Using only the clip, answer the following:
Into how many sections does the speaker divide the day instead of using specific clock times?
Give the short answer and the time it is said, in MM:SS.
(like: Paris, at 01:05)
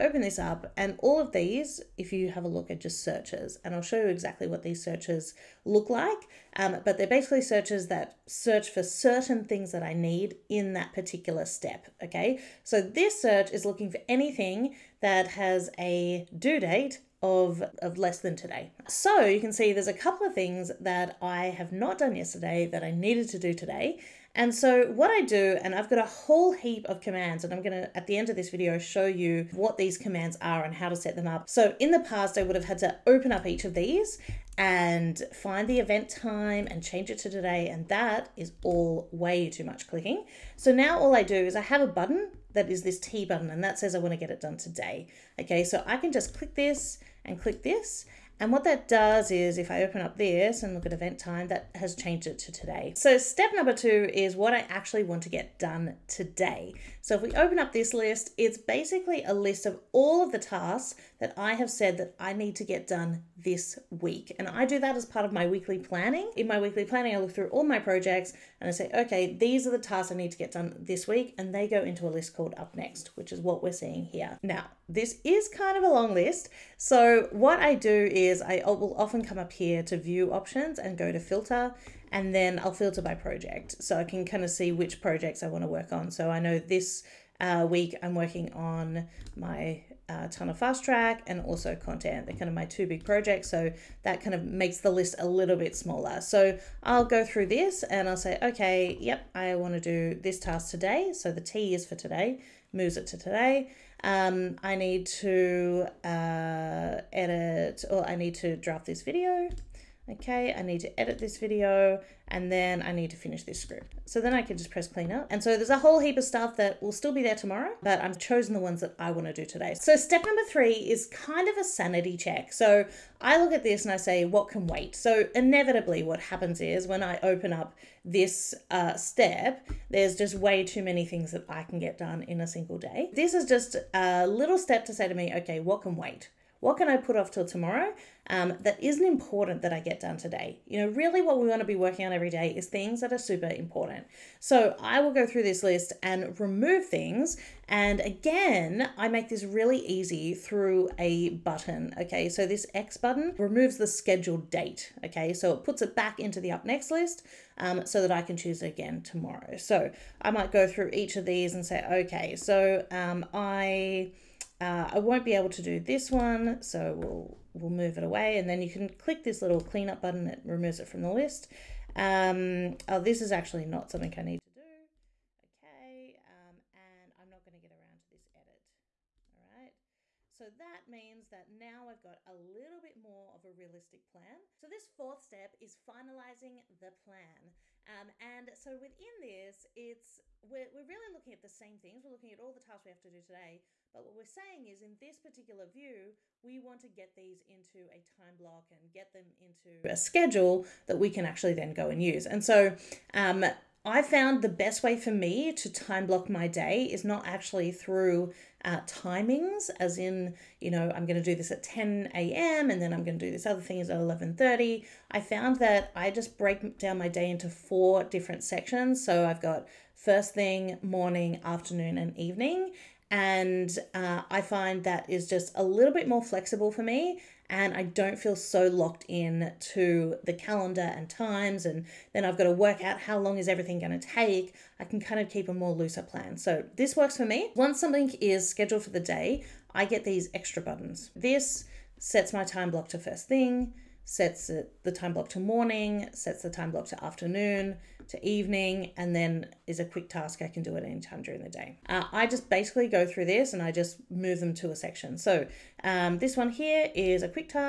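4, at 03:37.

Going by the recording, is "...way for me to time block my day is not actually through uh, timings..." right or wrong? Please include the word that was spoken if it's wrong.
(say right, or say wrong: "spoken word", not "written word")
right.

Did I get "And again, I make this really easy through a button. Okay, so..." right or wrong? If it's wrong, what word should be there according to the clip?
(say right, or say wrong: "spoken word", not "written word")
right.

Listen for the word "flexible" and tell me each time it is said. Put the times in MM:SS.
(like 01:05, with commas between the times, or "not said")
03:46.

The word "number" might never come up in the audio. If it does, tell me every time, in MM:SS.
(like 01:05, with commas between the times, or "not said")
00:53, 02:00.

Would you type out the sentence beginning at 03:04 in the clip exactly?
So this fourth step is finalizing the plan.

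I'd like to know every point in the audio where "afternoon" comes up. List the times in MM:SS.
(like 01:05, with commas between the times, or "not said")
03:41, 04:07.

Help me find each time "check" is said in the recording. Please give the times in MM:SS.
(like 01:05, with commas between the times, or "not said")
02:02.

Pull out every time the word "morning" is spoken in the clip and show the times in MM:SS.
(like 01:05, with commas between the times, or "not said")
03:40, 04:05.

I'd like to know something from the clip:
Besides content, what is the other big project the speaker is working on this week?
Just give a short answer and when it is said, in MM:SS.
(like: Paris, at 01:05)
Tana fast track, at 01:30.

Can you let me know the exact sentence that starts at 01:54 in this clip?
So then I can just press clean up.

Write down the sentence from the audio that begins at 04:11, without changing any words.
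Uh, I just basically go through this and I just move them to a section.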